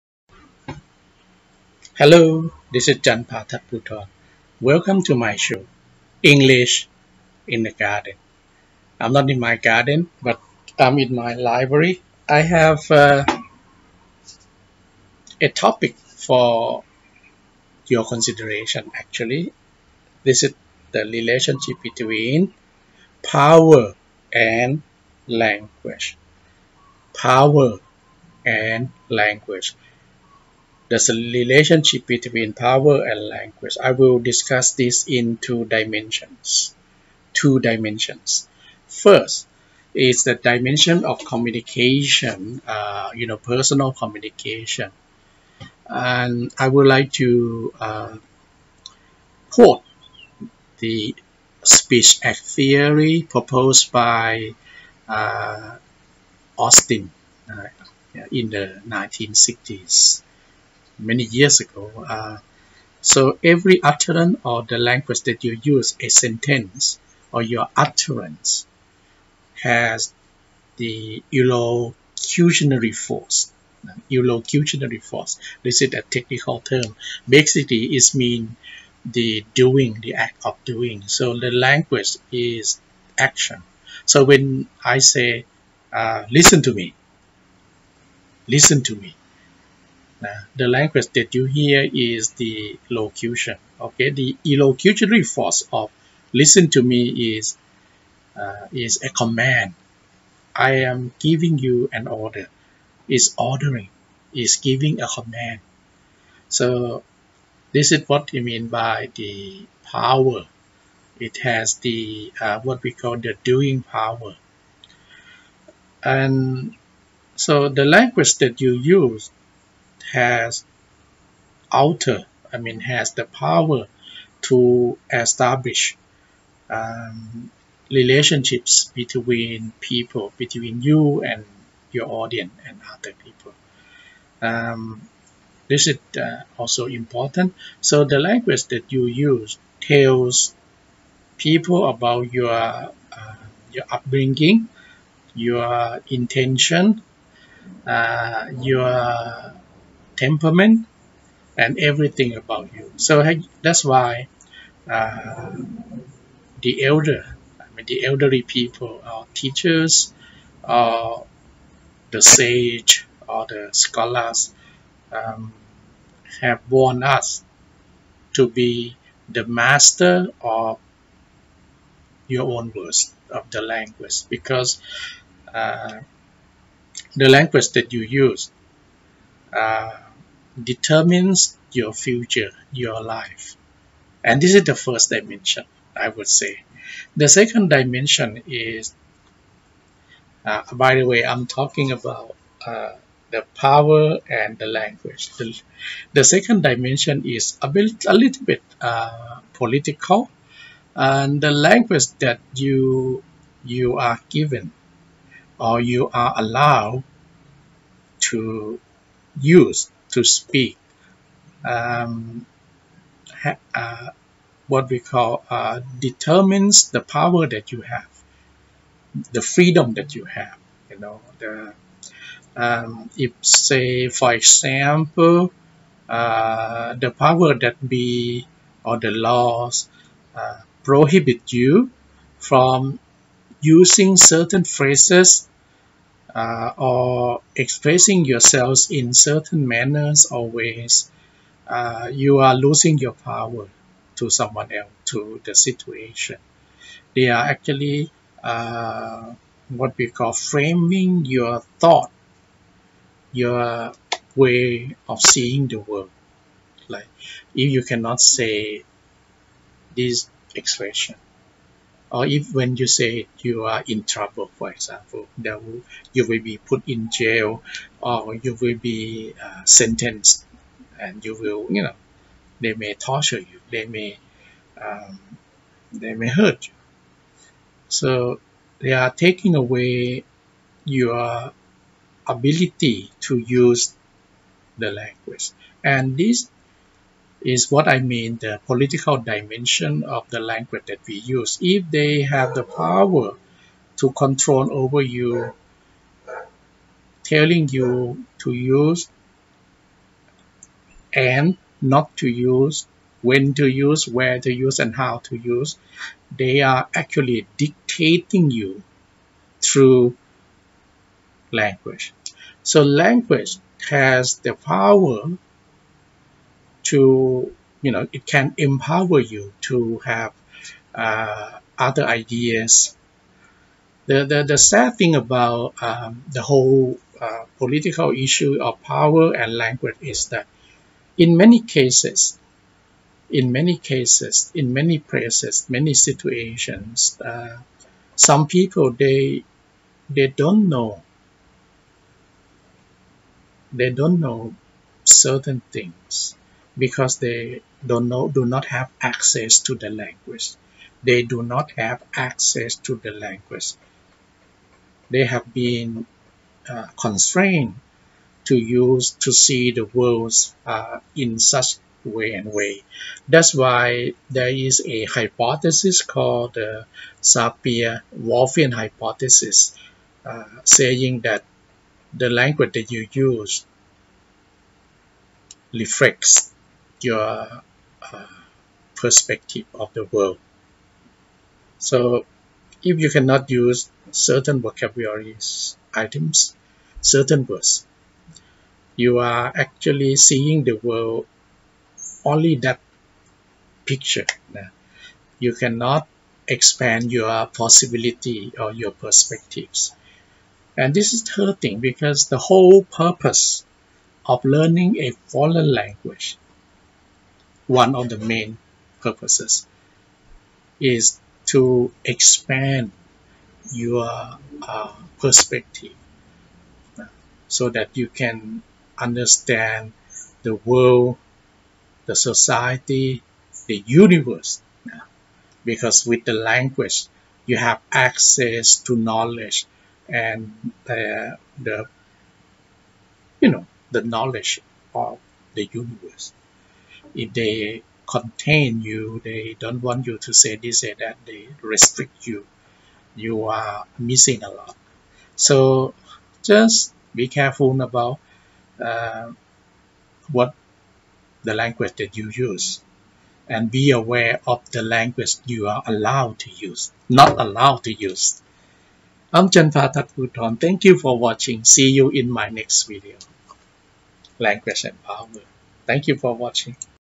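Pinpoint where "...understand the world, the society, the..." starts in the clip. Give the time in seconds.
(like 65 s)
418 s.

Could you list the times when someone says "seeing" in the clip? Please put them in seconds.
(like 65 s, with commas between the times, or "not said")
255 s, 390 s.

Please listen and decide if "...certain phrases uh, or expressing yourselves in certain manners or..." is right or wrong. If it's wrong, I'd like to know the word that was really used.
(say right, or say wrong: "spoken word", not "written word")
right.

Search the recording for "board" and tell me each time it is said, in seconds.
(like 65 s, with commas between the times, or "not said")
not said.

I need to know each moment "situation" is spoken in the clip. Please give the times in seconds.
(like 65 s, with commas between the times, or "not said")
245 s, 335 s.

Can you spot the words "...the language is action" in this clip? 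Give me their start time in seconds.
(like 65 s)
81 s.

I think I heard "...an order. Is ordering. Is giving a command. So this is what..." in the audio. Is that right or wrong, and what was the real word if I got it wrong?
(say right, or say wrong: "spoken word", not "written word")
right.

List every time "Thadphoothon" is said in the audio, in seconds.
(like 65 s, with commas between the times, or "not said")
3 s, 459 s.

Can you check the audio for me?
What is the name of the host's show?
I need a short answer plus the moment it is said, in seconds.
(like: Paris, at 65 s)
English in the Garden, at 6 s.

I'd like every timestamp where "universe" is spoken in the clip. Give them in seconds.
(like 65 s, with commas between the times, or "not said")
423 s, 435 s.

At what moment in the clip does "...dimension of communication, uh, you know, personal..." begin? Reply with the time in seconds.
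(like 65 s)
40 s.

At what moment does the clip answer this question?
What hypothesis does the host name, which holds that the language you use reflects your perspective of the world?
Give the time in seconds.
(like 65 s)
367 s.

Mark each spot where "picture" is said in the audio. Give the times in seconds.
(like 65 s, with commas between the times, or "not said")
393 s.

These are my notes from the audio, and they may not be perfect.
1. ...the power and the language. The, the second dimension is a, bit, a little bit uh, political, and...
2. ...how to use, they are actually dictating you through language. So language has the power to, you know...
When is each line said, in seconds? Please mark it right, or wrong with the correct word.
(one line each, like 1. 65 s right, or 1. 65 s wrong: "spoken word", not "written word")
1. 193 s right
2. 304 s right.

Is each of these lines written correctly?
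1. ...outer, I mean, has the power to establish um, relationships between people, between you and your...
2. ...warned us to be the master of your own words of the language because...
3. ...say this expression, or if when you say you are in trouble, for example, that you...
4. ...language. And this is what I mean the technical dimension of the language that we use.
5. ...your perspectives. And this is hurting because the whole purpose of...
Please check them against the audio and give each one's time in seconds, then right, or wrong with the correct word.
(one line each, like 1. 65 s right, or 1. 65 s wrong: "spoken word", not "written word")
1. 121 s right
2. 166 s right
3. 258 s right
4. 284 s wrong: "political", not "technical"
5. 398 s right.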